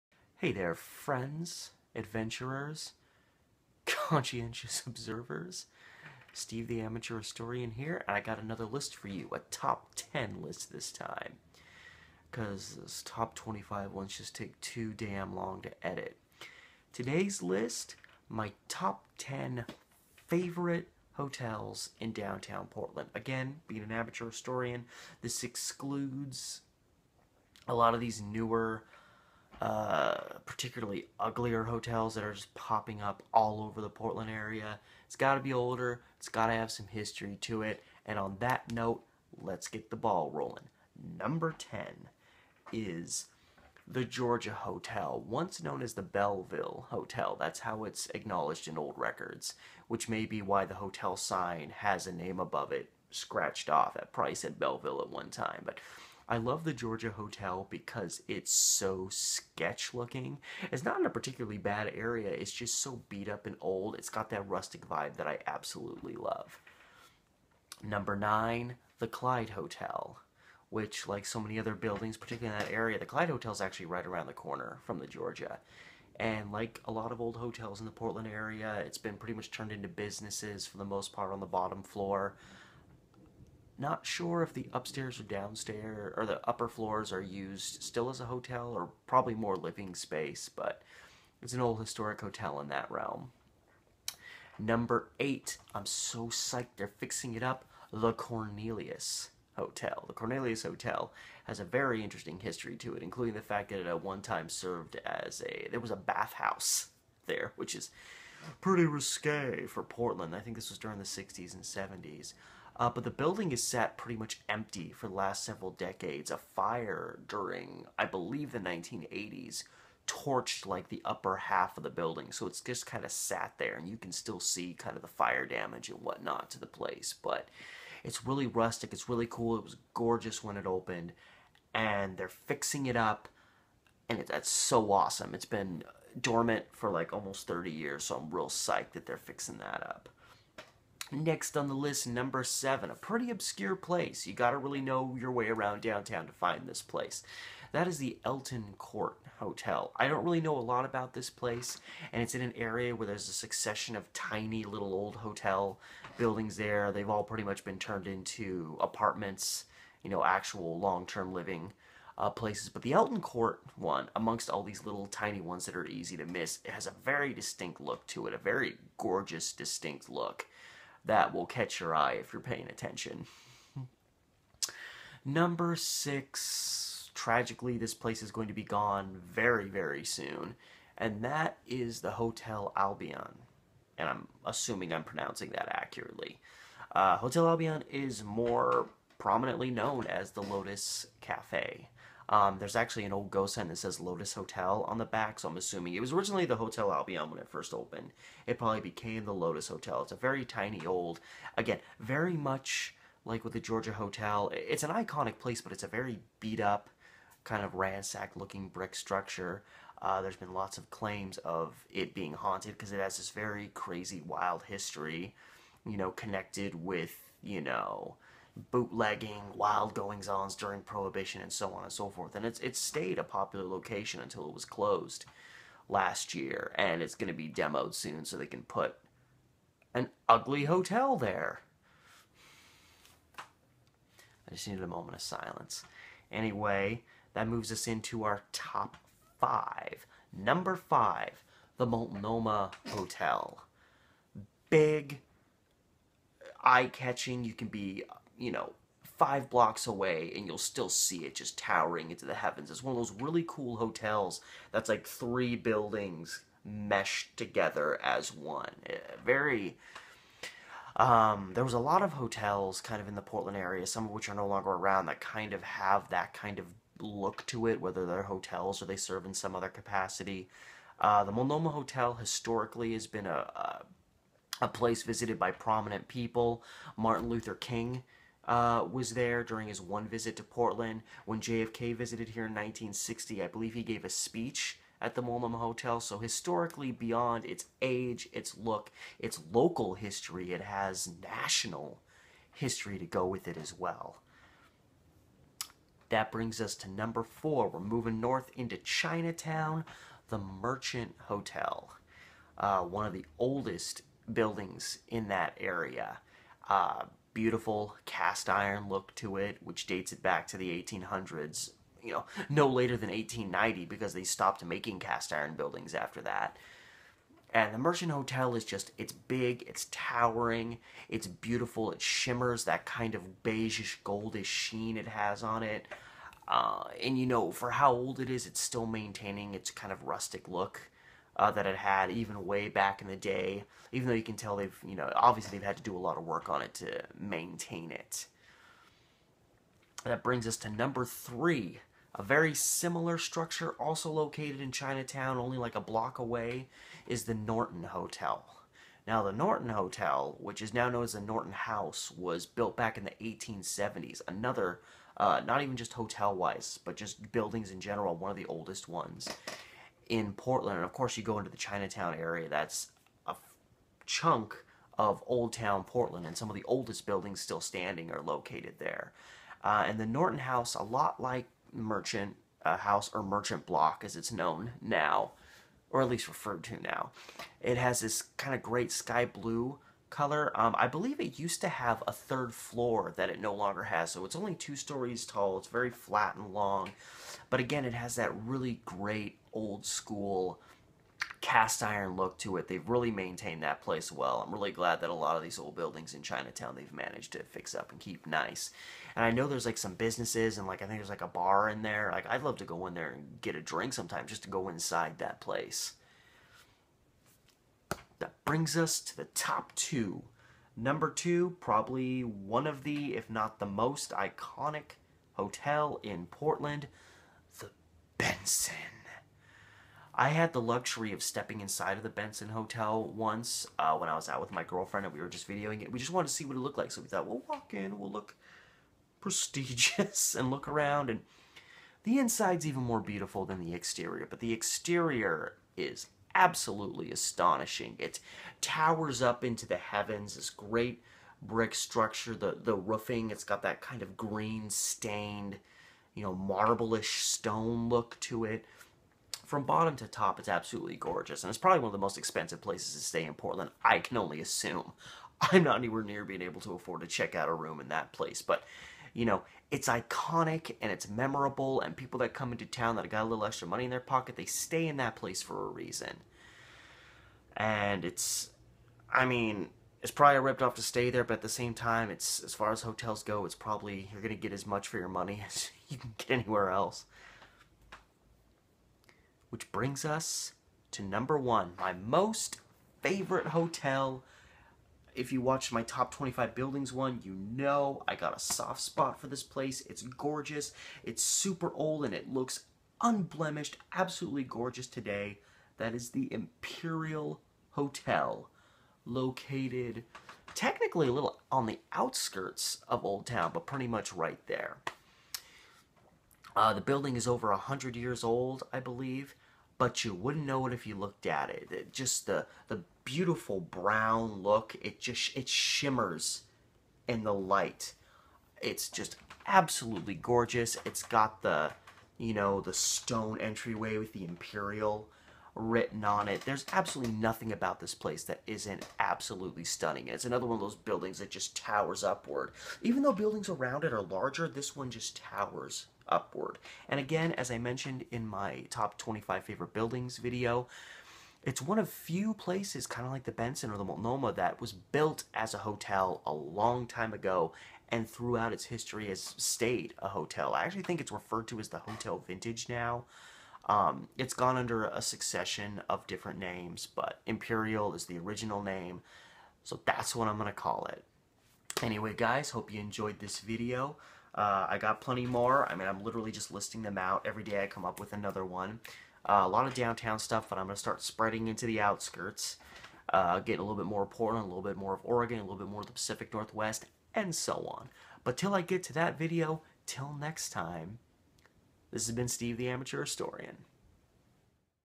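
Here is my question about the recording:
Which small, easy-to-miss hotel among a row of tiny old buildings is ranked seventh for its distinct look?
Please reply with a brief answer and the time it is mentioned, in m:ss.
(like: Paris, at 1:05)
Elton Court Hotel, at 2:28.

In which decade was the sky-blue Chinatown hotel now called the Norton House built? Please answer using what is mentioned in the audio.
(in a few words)
1870s.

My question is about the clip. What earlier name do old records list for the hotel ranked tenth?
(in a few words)
Belleville Hotel.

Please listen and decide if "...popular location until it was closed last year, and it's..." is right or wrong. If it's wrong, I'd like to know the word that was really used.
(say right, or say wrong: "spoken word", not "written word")
right.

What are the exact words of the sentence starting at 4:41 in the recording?
When JFK visited here in 1960, I believe he gave a speech at the Multnomah Hotel.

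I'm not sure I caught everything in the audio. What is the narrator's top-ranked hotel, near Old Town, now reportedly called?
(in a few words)
Hotel Vintage.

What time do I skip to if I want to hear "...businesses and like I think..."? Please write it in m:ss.
6:39.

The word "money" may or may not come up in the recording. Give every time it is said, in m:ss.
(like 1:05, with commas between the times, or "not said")
7:43, 7:55.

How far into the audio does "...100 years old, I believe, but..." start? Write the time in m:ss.
8:27.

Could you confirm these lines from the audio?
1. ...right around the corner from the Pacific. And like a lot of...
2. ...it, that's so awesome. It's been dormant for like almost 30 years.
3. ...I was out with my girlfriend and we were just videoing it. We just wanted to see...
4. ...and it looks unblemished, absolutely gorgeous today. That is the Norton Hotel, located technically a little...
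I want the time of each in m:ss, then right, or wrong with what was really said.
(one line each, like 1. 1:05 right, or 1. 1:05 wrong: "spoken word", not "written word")
1. 1:13 wrong: "Georgia", not "Pacific"
2. 2:14 right
3. 7:04 right
4. 8:12 wrong: "Imperial", not "Norton".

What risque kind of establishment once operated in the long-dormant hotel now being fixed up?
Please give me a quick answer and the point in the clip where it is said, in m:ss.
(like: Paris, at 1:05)
a bathhouse, at 1:45.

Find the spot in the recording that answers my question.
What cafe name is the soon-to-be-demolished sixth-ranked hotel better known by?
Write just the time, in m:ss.
3:10.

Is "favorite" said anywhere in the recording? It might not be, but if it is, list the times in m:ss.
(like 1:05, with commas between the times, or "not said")
0:20, 8:03, 8:59.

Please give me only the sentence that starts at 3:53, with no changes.
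I just needed a moment of silence.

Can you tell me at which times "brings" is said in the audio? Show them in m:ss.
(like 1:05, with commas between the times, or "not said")
4:56, 5:40, 6:48, 7:59.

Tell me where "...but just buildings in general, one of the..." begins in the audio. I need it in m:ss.
5:56.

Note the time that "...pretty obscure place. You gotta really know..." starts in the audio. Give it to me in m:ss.
2:22.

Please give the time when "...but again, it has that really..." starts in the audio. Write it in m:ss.
6:27.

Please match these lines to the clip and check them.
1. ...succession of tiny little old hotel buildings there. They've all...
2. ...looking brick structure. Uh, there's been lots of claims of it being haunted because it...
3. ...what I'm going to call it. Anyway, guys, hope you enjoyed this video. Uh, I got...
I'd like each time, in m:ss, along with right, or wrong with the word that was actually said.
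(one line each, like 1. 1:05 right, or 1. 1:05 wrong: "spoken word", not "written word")
1. 2:33 right
2. 3:28 right
3. 9:20 right.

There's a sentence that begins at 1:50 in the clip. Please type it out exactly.
I think this was during the 60s and 70s.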